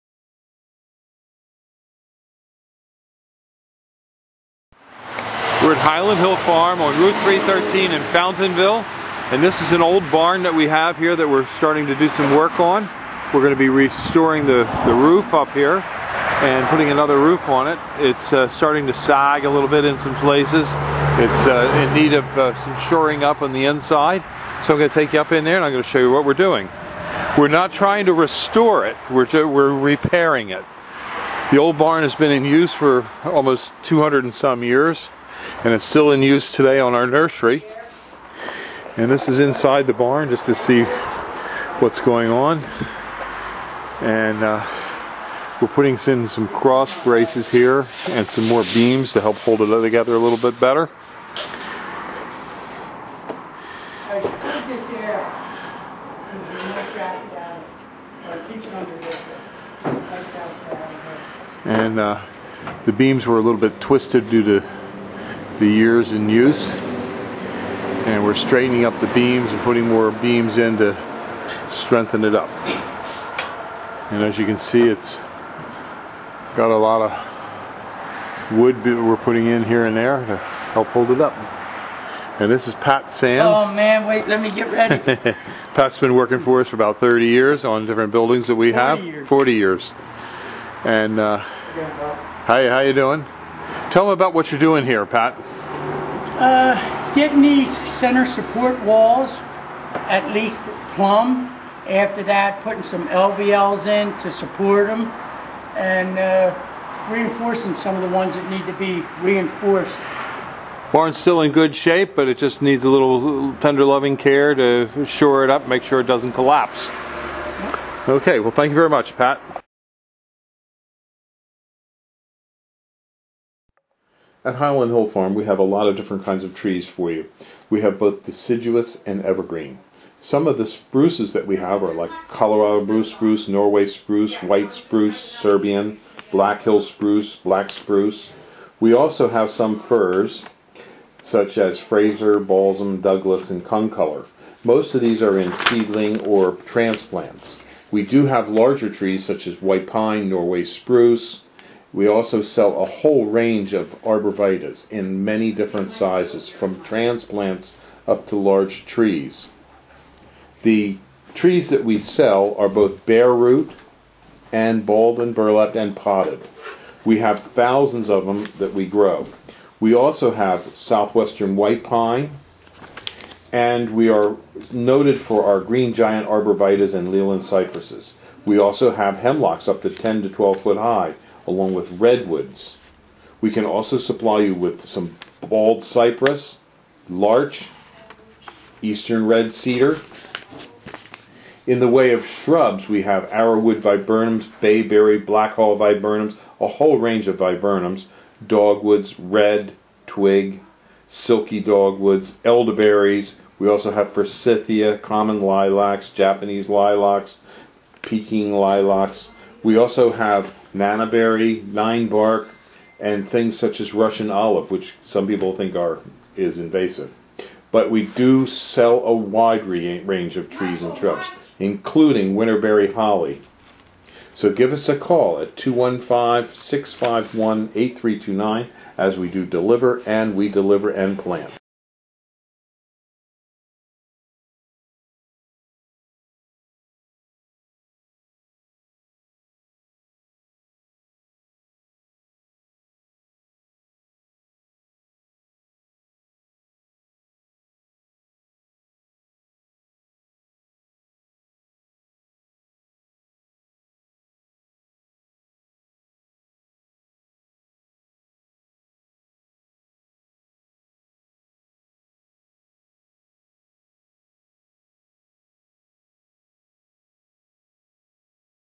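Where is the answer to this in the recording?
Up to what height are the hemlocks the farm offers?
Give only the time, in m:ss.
2:59.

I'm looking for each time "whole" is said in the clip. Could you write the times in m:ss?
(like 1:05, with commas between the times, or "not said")
2:32, 3:16.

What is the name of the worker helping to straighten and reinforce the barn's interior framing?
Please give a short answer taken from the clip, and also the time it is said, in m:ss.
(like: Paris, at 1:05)
Pat Sands, at 1:22.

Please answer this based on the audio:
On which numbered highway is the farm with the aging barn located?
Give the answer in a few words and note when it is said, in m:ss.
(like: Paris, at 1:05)
Route 313, at 0:06.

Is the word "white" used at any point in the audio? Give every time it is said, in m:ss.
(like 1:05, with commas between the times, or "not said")
2:14, 2:29, 2:51.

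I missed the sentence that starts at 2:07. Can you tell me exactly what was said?
We have both deciduous and evergreen.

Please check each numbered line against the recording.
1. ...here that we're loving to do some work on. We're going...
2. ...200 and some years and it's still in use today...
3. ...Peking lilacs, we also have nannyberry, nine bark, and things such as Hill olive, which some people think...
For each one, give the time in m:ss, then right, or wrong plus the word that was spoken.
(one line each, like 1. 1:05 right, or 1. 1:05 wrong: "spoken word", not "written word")
1. 0:10 wrong: "starting", not "loving"
2. 0:33 right
3. 3:28 wrong: "Russian", not "Hill".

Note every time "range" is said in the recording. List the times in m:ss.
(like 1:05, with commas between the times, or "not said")
2:33, 3:16, 3:39.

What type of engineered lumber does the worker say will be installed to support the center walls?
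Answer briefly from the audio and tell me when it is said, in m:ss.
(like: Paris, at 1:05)
LVLs, at 1:43.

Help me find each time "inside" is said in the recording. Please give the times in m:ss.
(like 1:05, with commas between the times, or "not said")
0:23, 0:39.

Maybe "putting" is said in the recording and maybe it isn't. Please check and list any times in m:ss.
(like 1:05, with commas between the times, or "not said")
0:16, 0:45, 1:09, 1:19, 1:42.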